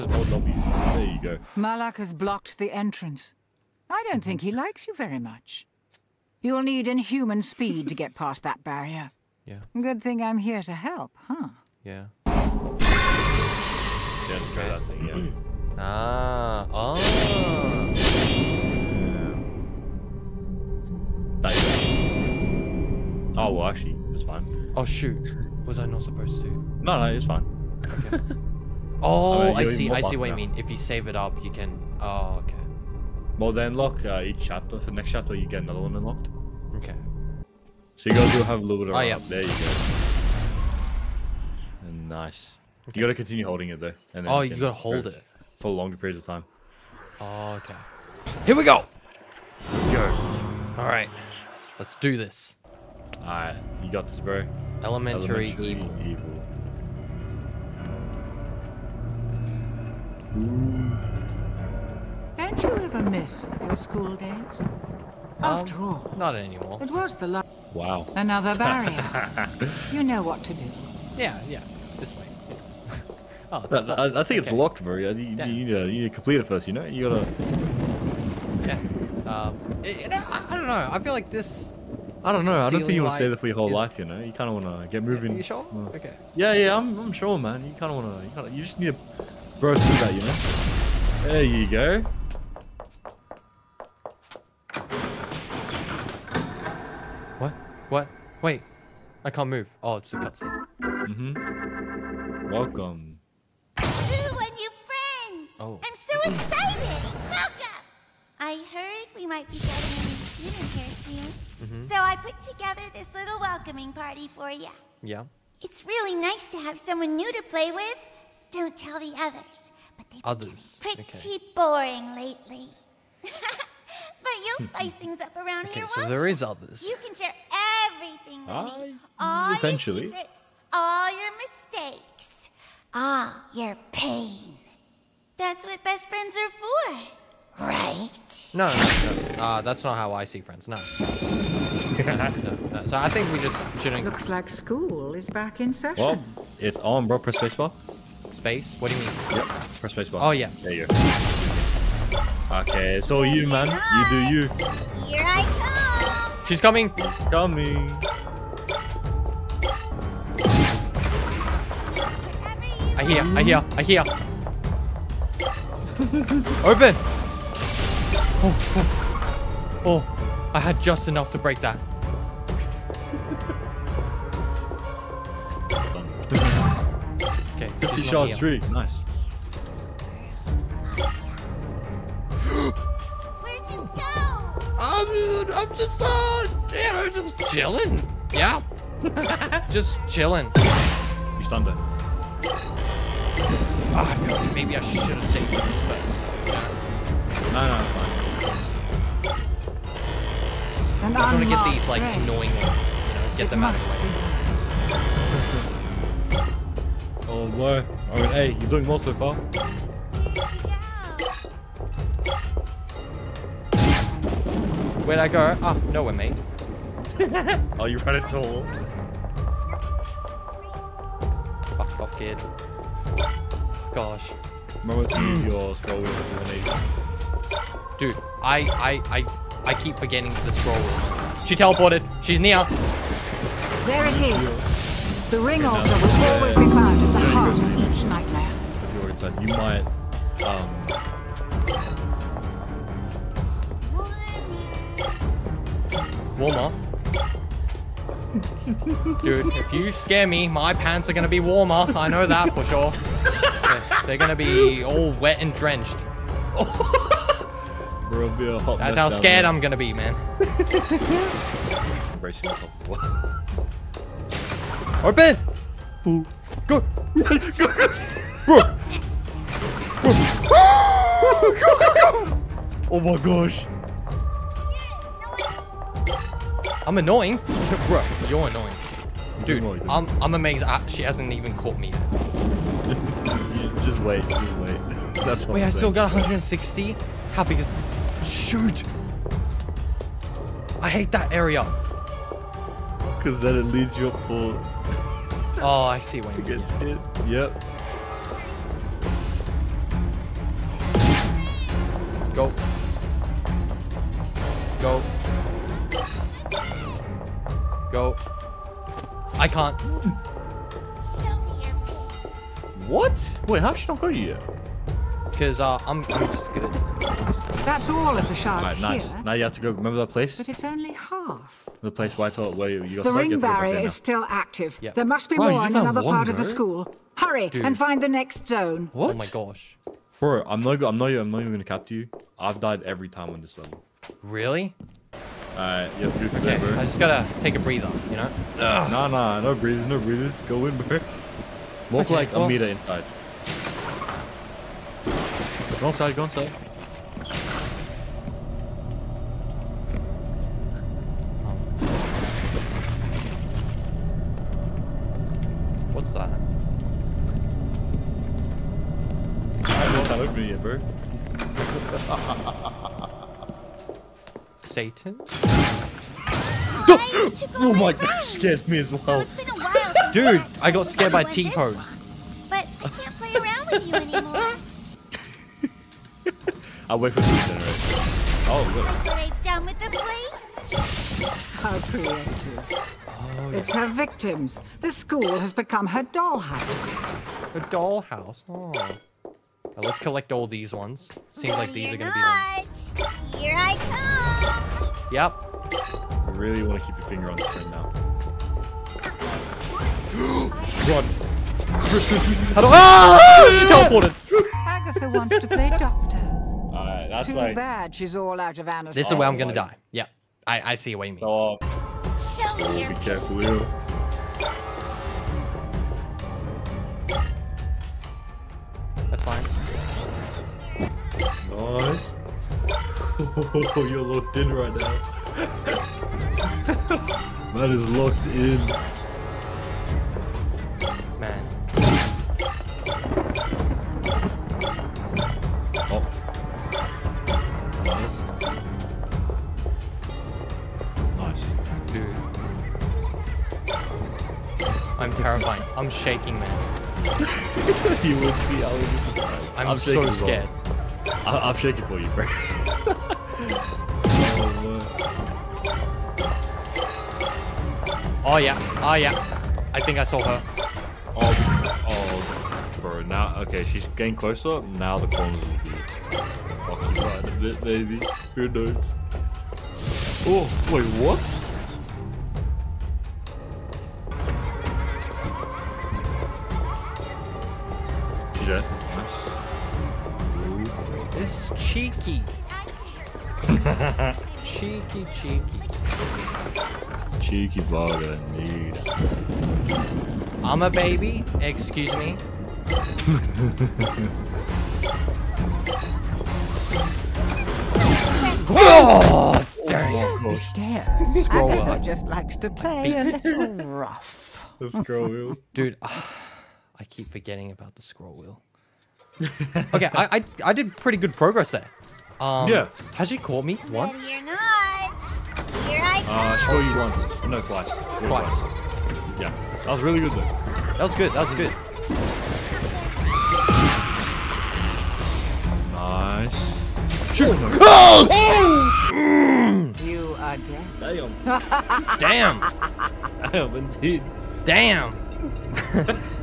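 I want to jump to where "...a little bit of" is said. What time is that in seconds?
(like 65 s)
38 s.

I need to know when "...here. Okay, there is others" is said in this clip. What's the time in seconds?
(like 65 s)
125 s.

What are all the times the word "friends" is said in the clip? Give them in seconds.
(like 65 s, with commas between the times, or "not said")
136 s, 140 s.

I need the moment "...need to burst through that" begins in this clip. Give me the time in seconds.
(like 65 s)
88 s.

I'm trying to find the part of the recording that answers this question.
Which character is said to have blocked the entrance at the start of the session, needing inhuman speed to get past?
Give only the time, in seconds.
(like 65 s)
1 s.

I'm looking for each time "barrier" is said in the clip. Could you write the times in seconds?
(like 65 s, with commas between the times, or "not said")
8 s, 68 s, 323 s.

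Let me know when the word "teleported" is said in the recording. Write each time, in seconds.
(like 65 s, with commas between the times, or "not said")
231 s, 403 s.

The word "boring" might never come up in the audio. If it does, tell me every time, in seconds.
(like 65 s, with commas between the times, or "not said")
121 s.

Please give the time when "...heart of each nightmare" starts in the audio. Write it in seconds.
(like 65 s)
237 s.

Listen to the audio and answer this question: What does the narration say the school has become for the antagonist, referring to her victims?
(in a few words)
Her dollhouse.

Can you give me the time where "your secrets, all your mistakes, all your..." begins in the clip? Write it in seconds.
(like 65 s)
130 s.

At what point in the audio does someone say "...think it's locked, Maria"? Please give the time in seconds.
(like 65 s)
74 s.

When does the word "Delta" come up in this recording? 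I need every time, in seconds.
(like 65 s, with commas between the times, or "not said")
not said.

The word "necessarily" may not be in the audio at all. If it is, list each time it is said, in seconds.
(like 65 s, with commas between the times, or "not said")
not said.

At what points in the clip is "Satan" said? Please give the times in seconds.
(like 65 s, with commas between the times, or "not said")
364 s.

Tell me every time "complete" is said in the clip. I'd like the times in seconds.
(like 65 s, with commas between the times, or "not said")
76 s.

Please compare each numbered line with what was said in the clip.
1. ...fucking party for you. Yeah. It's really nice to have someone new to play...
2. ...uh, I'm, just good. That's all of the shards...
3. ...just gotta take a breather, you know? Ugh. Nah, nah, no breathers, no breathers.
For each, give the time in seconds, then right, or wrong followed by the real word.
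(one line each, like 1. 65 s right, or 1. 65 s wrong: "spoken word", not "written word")
1. 113 s wrong: "welcoming", not "fucking"
2. 315 s right
3. 336 s right.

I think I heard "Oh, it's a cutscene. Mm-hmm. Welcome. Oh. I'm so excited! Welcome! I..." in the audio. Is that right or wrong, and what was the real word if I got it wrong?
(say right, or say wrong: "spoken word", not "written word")
right.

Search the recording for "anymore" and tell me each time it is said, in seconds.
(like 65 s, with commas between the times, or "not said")
66 s, 373 s.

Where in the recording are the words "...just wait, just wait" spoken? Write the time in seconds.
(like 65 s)
283 s.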